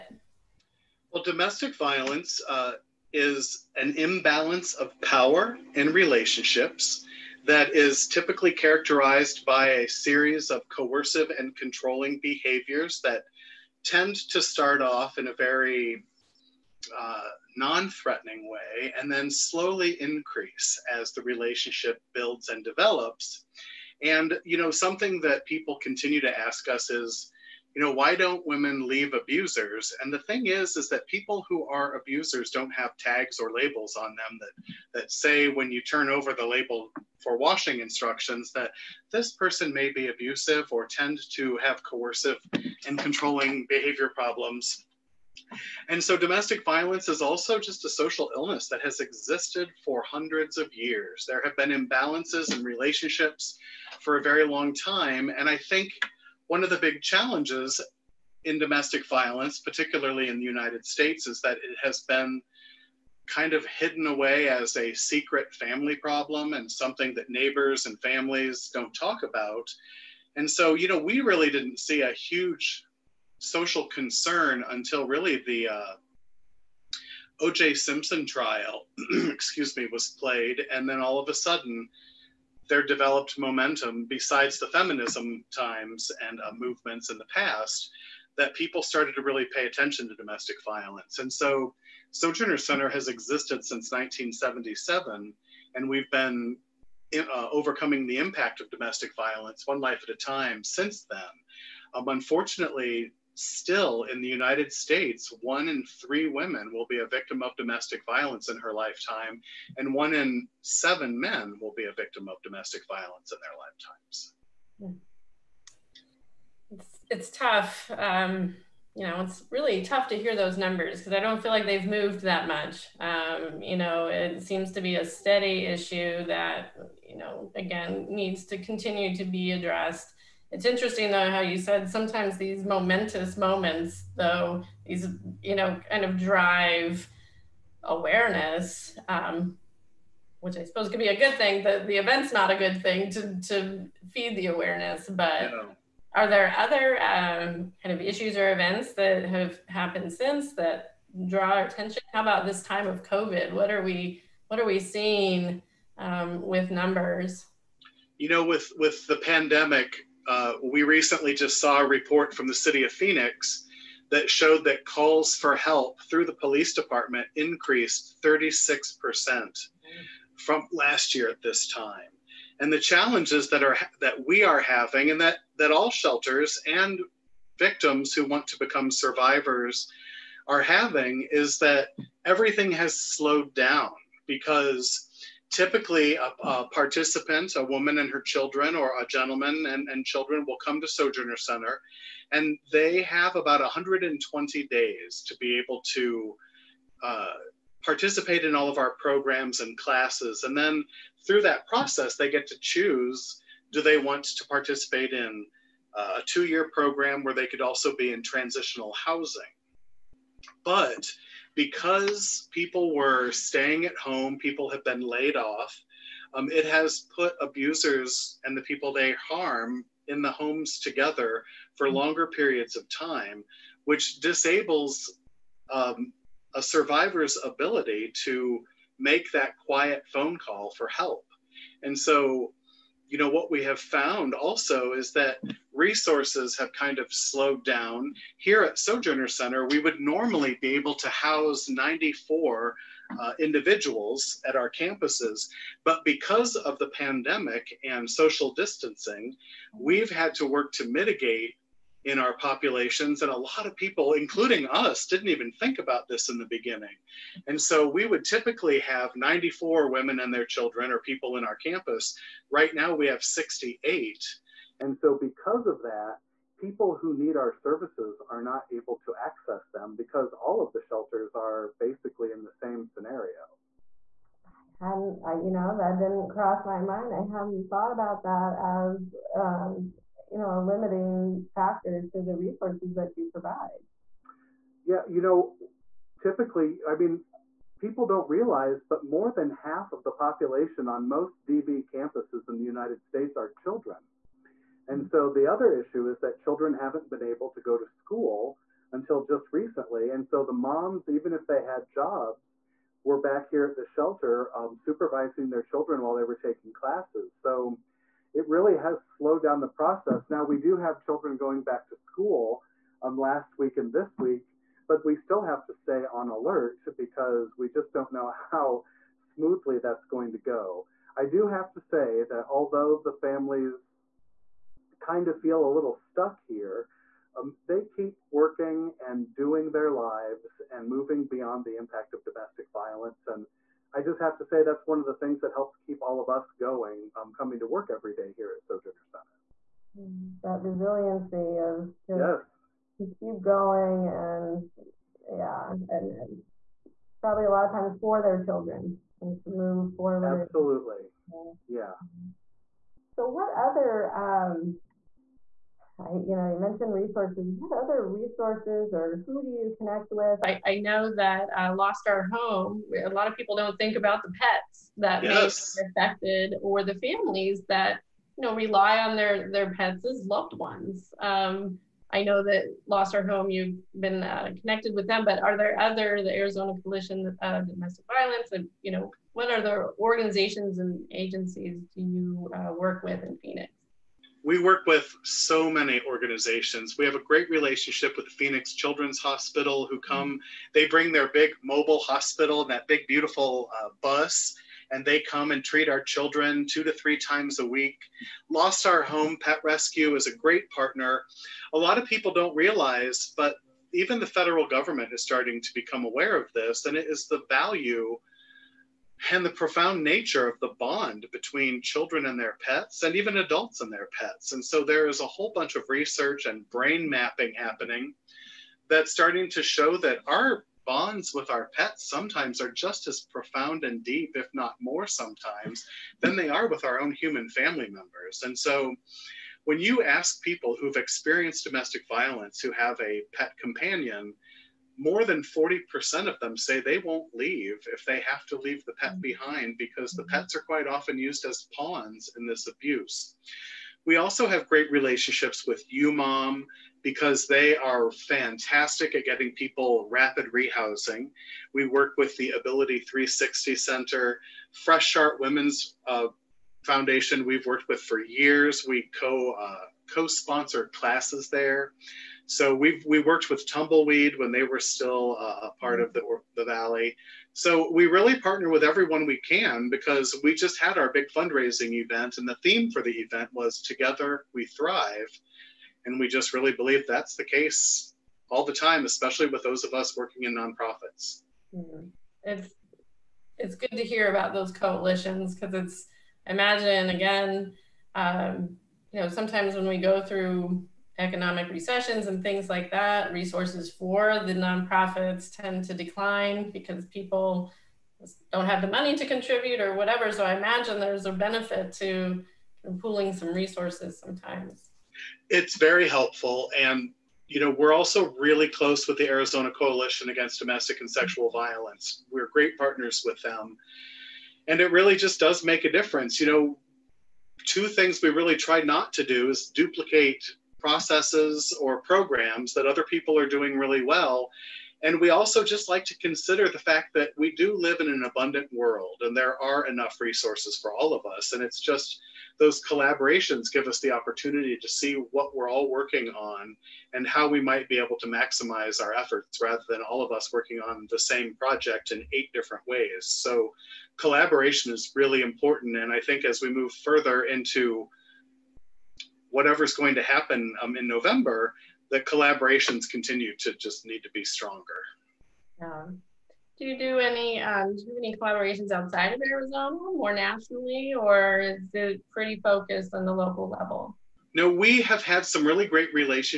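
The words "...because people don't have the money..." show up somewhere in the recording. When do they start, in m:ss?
8:16.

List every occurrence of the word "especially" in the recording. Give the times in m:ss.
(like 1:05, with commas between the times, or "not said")
7:59.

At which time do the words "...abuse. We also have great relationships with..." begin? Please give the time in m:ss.
7:22.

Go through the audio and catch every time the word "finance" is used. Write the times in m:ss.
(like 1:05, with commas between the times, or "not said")
not said.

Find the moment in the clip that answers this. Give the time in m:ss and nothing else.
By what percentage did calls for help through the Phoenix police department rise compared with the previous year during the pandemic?
2:48.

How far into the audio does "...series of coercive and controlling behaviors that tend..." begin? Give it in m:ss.
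0:09.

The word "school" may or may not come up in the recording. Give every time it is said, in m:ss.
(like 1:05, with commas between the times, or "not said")
4:57, 5:11.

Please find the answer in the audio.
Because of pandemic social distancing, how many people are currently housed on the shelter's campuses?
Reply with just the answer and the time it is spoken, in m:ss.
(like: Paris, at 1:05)
68, at 4:23.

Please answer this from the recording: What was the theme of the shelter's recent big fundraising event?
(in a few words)
Together We Thrive.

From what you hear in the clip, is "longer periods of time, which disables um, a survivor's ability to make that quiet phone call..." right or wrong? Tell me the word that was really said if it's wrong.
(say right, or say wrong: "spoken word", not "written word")
right.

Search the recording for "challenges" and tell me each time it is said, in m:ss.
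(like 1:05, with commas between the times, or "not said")
0:57, 2:52.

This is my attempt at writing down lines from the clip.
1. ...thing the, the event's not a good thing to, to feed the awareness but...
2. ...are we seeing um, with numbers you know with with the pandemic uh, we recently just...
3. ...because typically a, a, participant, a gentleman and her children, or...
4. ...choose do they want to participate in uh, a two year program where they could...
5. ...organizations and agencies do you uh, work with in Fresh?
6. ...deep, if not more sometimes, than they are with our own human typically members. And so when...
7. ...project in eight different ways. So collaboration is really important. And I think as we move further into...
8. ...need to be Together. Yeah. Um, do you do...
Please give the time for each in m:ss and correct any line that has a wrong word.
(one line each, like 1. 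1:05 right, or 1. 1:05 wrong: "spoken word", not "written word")
1. 2:21 right
2. 2:34 right
3. 3:04 wrong: "woman", not "gentleman"
4. 3:22 right
5. 6:19 wrong: "Phoenix", not "Fresh"
6. 7:04 wrong: "family", not "typically"
7. 9:01 right
8. 9:14 wrong: "stronger", not "Together".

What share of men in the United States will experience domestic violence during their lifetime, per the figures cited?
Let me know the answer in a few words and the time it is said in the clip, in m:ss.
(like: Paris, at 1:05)
1 in 7, at 1:49.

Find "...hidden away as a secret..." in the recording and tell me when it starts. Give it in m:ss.
1:03.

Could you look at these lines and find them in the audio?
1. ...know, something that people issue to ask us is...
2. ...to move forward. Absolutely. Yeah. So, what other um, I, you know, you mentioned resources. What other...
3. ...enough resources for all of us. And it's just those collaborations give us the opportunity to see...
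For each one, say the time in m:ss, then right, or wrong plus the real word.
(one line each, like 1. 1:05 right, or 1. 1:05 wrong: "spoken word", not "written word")
1. 0:24 wrong: "continue", not "issue"
2. 5:49 right
3. 8:49 right.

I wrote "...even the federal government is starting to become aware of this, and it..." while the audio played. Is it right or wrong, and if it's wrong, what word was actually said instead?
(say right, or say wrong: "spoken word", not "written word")
right.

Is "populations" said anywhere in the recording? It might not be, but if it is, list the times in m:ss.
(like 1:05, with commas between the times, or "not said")
4:12, 4:50.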